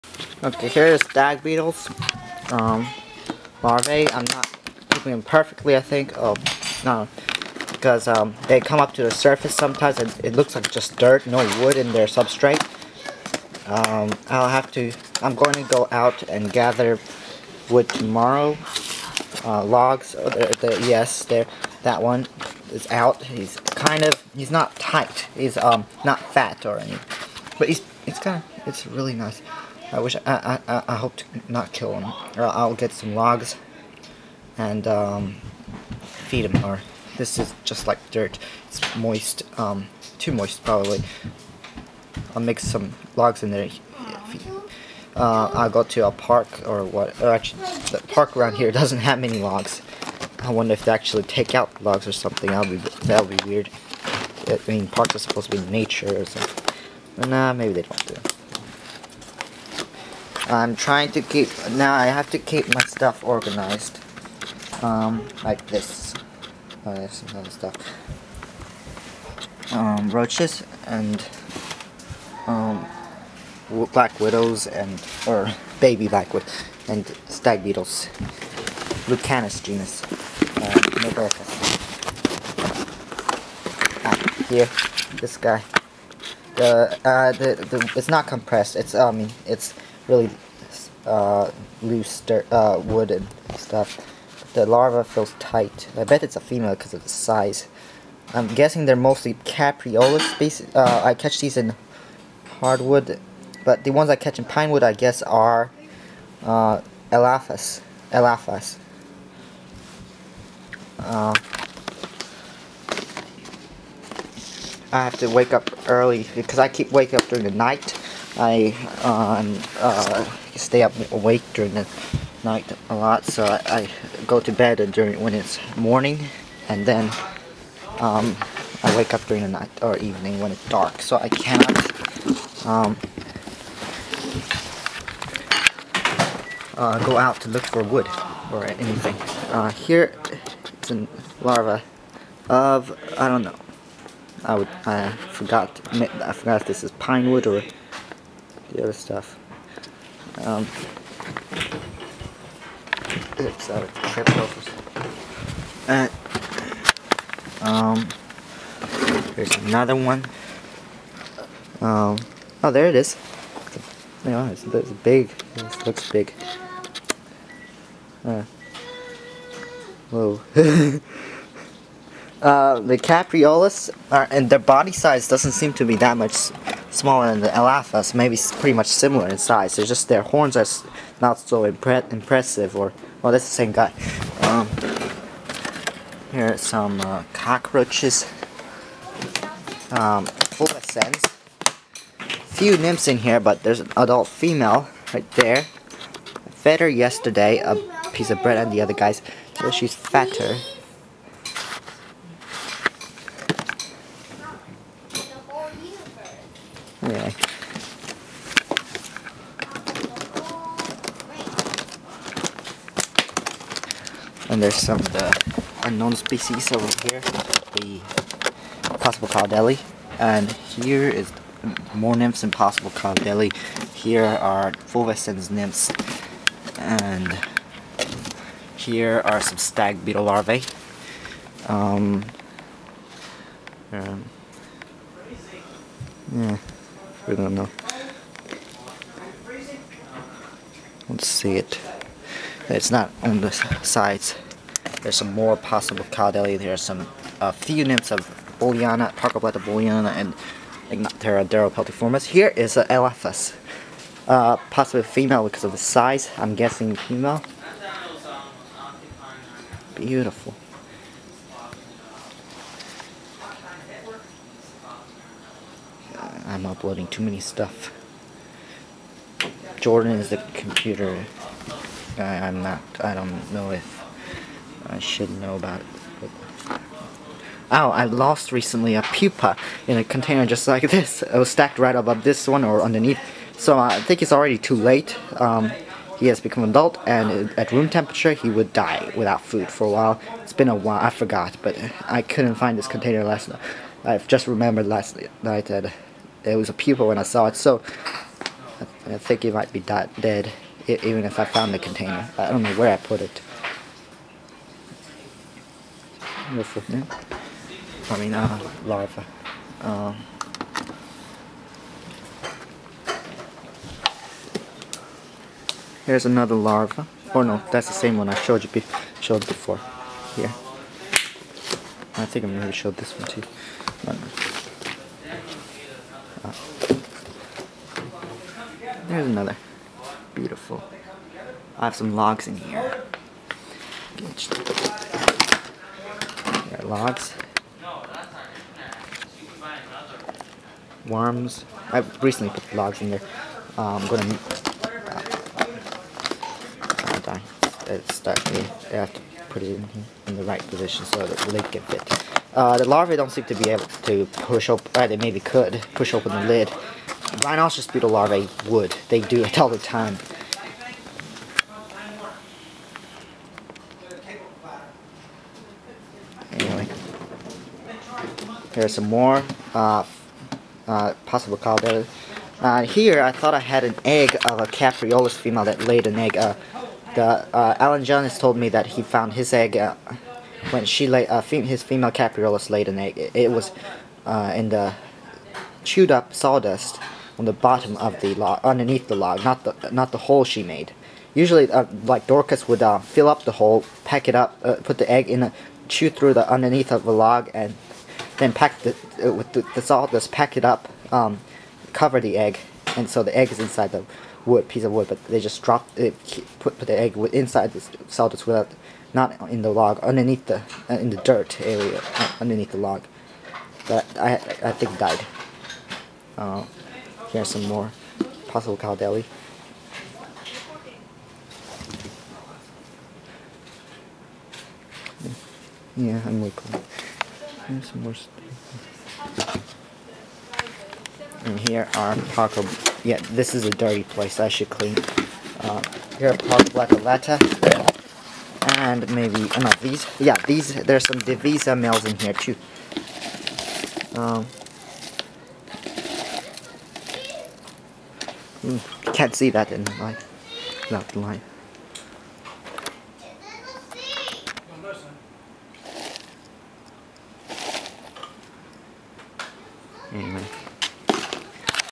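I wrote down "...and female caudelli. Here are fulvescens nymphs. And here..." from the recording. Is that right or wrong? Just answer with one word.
wrong.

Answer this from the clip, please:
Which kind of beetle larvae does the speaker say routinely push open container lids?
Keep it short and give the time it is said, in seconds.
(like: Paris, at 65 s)
Rhinoceros beetle larvae, at 357 s.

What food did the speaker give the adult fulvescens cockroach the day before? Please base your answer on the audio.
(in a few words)
A piece of bread.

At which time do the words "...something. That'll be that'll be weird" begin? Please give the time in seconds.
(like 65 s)
52 s.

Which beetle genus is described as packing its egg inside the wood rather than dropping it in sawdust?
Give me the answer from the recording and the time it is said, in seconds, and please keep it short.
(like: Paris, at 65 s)
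Dorcus, at 392 s.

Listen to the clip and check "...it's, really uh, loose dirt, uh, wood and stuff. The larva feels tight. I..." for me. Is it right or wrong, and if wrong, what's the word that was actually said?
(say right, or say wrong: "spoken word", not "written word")
right.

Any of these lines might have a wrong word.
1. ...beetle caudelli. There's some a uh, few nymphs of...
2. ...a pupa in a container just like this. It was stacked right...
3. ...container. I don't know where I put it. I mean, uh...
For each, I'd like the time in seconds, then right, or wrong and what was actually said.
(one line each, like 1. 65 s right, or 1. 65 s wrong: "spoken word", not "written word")
1. 245 s wrong: "possible", not "beetle"
2. 278 s right
3. 301 s right.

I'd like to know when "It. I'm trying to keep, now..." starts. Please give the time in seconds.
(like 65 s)
58 s.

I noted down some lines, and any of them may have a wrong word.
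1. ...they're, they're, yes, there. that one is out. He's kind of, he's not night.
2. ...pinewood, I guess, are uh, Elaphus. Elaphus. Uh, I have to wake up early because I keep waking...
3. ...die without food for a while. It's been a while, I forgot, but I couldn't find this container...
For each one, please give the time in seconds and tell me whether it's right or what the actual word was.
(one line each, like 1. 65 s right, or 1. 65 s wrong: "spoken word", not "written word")
1. 20 s wrong: "tight", not "night"
2. 104 s right
3. 288 s right.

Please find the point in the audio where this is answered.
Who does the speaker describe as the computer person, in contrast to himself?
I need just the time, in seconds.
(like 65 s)
269 s.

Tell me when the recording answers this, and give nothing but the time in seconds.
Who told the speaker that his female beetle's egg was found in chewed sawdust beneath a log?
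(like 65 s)
377 s.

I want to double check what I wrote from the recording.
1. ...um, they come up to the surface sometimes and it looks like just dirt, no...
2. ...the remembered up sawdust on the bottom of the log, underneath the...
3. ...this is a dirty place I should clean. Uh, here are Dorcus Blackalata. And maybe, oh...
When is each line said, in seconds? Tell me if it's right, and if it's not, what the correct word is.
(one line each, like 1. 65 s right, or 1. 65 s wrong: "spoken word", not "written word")
1. 8 s right
2. 384 s wrong: "chewed", not "remembered"
3. 433 s wrong: "Paco", not "Dorcus".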